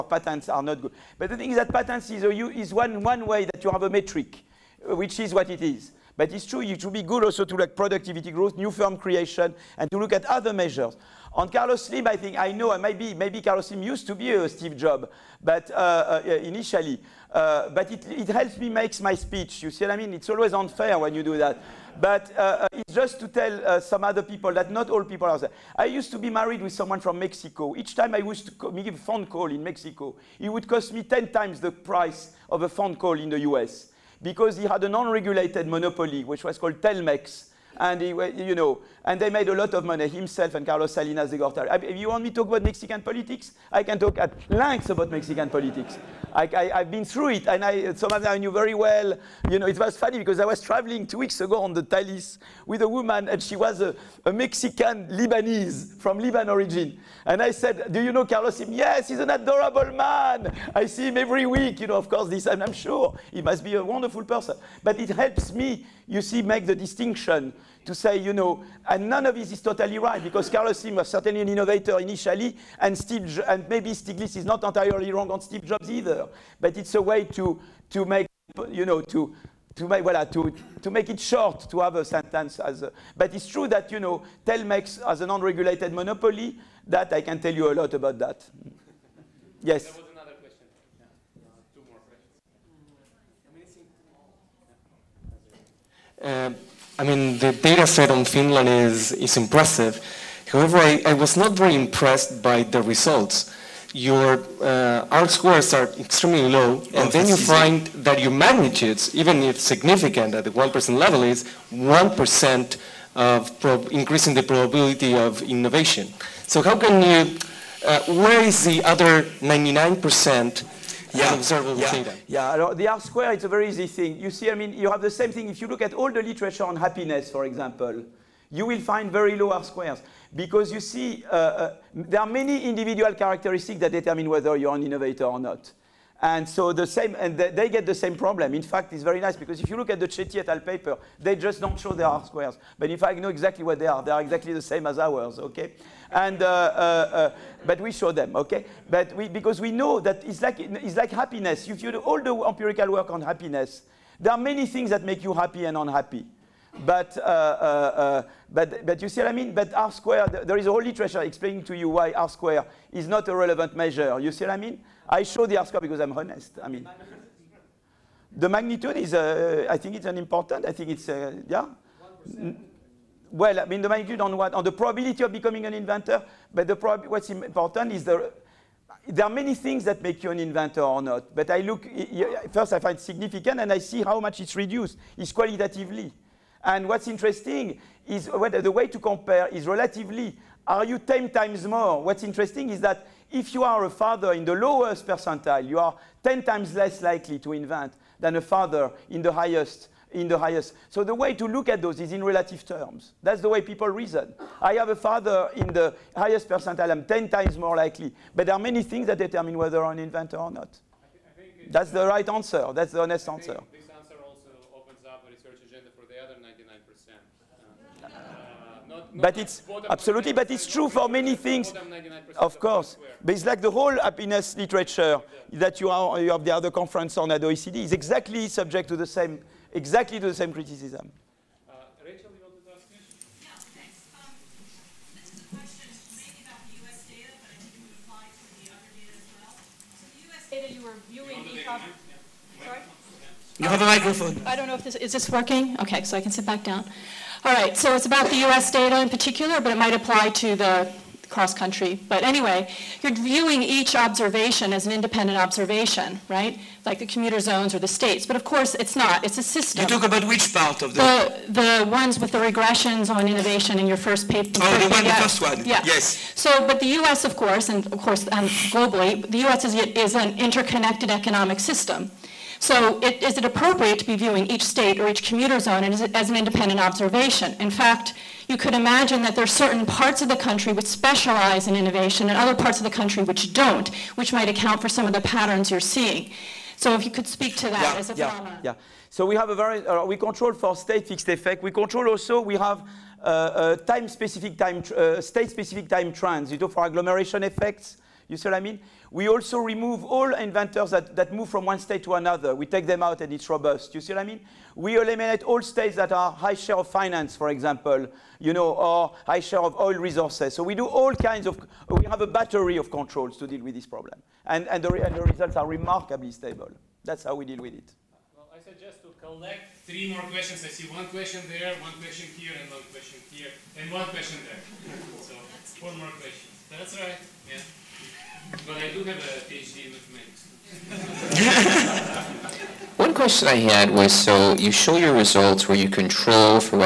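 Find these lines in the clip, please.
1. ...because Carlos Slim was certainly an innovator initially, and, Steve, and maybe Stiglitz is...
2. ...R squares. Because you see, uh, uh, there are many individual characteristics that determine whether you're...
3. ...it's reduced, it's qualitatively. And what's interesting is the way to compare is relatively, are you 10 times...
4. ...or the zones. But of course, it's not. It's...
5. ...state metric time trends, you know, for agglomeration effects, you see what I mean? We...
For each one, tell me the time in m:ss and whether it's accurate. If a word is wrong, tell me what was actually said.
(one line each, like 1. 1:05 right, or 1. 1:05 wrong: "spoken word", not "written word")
1. 1:10 right
2. 2:09 right
3. 3:04 right
4. 4:17 wrong: "states", not "zones"
5. 4:55 wrong: "specific", not "metric".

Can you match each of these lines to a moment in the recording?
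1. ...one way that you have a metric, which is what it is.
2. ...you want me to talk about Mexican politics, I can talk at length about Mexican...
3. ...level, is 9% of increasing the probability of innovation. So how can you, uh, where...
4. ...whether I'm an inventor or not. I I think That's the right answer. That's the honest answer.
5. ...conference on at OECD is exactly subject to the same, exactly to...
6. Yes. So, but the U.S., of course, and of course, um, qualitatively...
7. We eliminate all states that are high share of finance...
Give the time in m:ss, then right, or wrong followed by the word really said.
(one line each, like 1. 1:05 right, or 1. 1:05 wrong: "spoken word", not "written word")
1. 0:03 right
2. 0:41 right
3. 1:50 wrong: "1", not "9"
4. 3:29 right
5. 3:46 right
6. 4:25 wrong: "globally", not "qualitatively"
7. 5:04 right.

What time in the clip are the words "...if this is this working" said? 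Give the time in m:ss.
4:04.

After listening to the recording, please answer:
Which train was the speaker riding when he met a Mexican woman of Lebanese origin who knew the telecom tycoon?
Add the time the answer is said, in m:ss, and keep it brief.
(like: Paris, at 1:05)
Thalys, at 0:51.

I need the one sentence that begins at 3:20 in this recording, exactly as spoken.
So the way to look at those is in relative terms.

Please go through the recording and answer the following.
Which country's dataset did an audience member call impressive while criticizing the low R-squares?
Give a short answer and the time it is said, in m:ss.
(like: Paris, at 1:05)
Finland, at 1:38.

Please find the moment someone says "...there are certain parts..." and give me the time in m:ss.
4:39.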